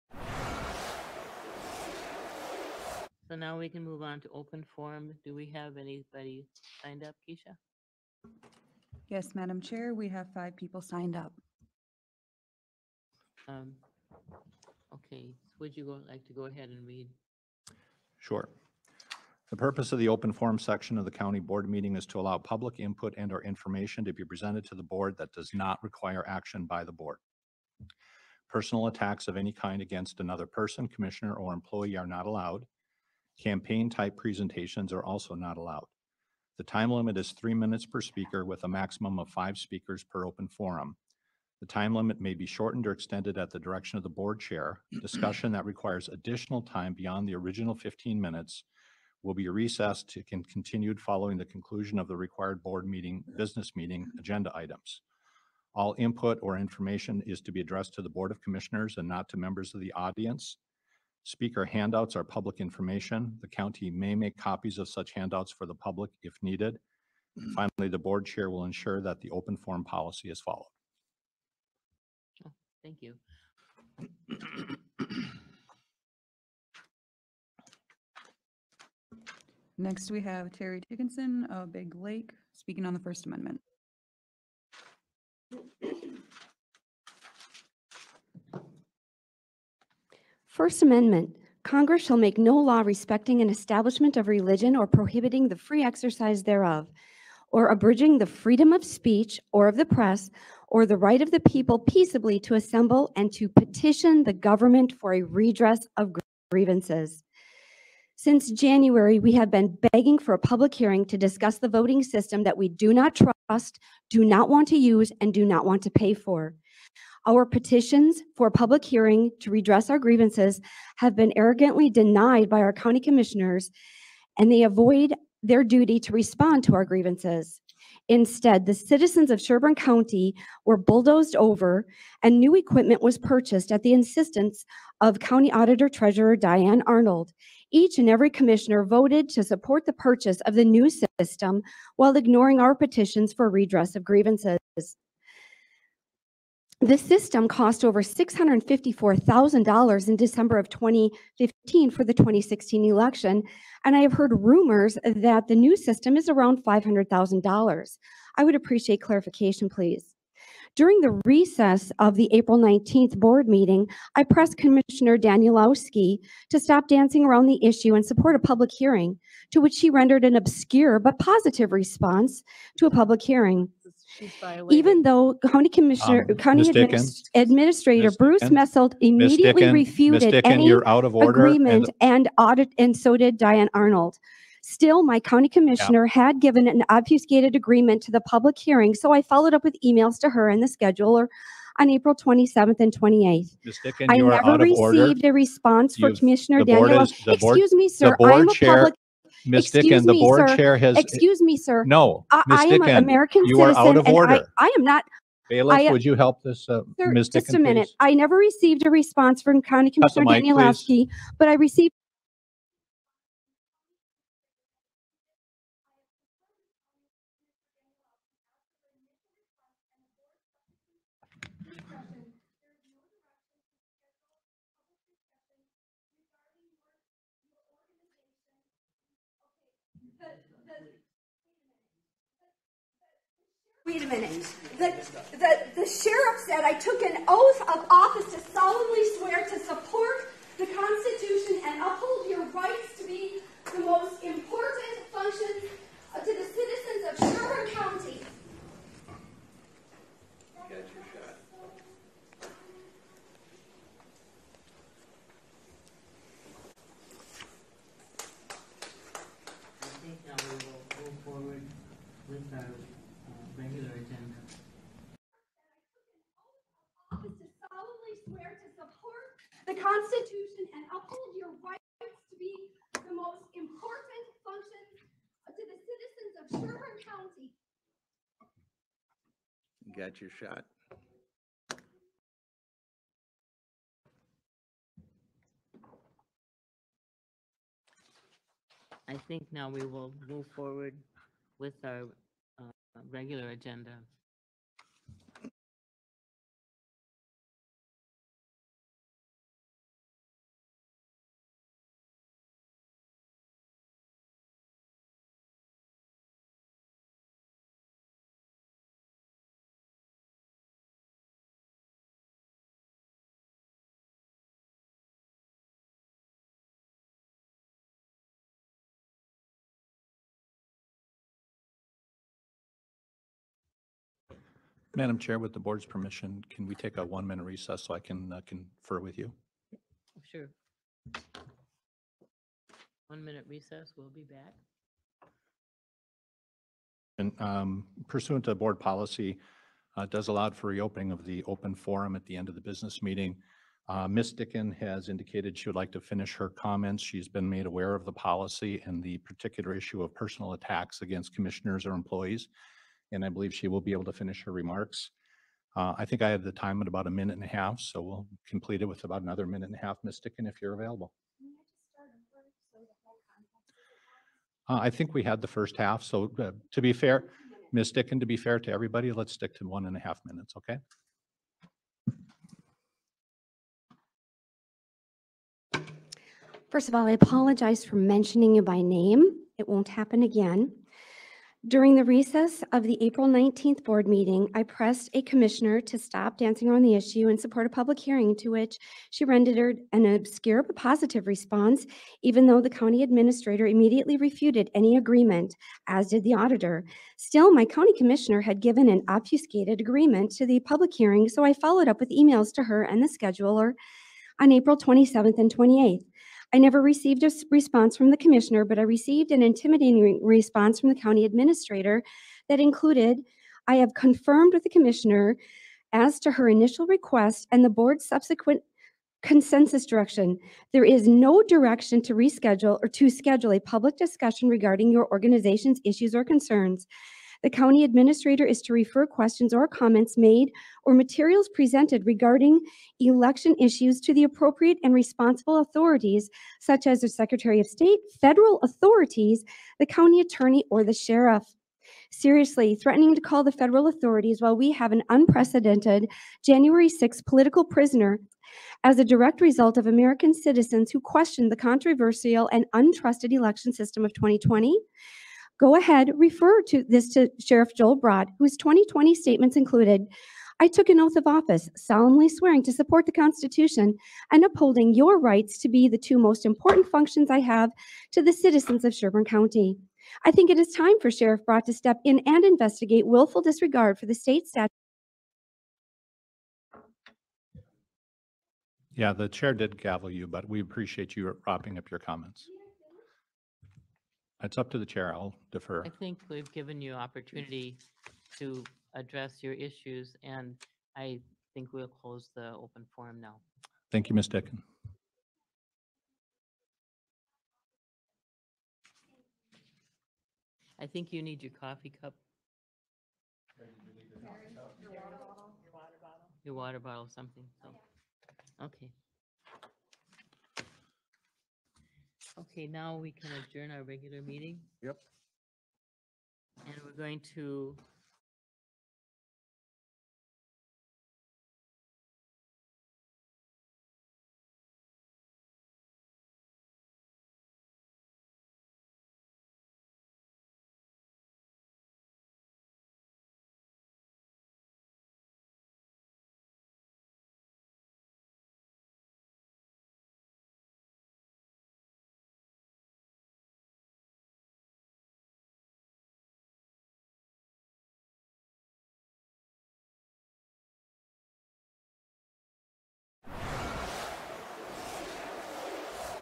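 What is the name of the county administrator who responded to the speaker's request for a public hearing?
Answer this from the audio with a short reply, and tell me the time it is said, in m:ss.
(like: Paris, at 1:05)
Bruce Messelt, at 2:58.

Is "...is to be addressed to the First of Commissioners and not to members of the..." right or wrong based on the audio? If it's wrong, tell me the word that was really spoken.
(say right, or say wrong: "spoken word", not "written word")
wrong: "Board", not "First".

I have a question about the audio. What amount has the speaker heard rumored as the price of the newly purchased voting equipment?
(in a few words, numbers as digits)
$500,000.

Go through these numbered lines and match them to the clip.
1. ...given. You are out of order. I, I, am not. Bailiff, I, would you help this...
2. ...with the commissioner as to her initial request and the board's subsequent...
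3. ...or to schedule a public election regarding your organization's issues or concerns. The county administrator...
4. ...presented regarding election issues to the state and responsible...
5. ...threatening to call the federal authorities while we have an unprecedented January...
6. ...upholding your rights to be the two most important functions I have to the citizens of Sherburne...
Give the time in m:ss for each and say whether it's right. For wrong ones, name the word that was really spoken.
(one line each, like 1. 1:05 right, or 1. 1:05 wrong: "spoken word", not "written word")
1. 3:23 wrong: "citizen", not "given"
2. 6:54 right
3. 7:02 wrong: "discussion", not "election"
4. 7:11 wrong: "appropriate", not "state"
5. 7:22 right
6. 7:44 right.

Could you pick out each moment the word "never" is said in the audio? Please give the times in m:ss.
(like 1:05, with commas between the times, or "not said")
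3:14, 3:28, 6:46.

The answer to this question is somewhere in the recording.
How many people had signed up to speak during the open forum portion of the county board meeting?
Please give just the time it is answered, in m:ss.
0:10.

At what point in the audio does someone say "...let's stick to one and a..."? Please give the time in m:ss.
6:09.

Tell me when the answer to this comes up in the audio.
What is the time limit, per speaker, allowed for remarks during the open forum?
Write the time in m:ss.
0:37.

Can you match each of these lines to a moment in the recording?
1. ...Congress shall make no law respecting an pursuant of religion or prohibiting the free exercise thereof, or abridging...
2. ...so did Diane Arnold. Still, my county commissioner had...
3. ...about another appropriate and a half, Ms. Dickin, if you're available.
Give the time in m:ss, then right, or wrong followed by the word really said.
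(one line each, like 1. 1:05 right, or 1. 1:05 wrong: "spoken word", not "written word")
1. 1:31 wrong: "establishment", not "pursuant"
2. 3:02 right
3. 5:59 wrong: "minute", not "appropriate".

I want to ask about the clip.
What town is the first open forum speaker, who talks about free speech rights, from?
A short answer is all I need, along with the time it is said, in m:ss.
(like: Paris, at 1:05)
Big Lake, at 1:21.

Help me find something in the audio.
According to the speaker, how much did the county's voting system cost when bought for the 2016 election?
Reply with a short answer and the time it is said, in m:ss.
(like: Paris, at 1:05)
Over $654,000, at 2:27.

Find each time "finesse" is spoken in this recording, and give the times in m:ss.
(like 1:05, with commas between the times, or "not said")
not said.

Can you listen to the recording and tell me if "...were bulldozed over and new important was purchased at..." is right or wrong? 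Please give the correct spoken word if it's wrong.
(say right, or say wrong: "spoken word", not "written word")
wrong: "equipment", not "important".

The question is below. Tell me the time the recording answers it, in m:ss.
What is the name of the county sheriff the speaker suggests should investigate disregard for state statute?
7:37.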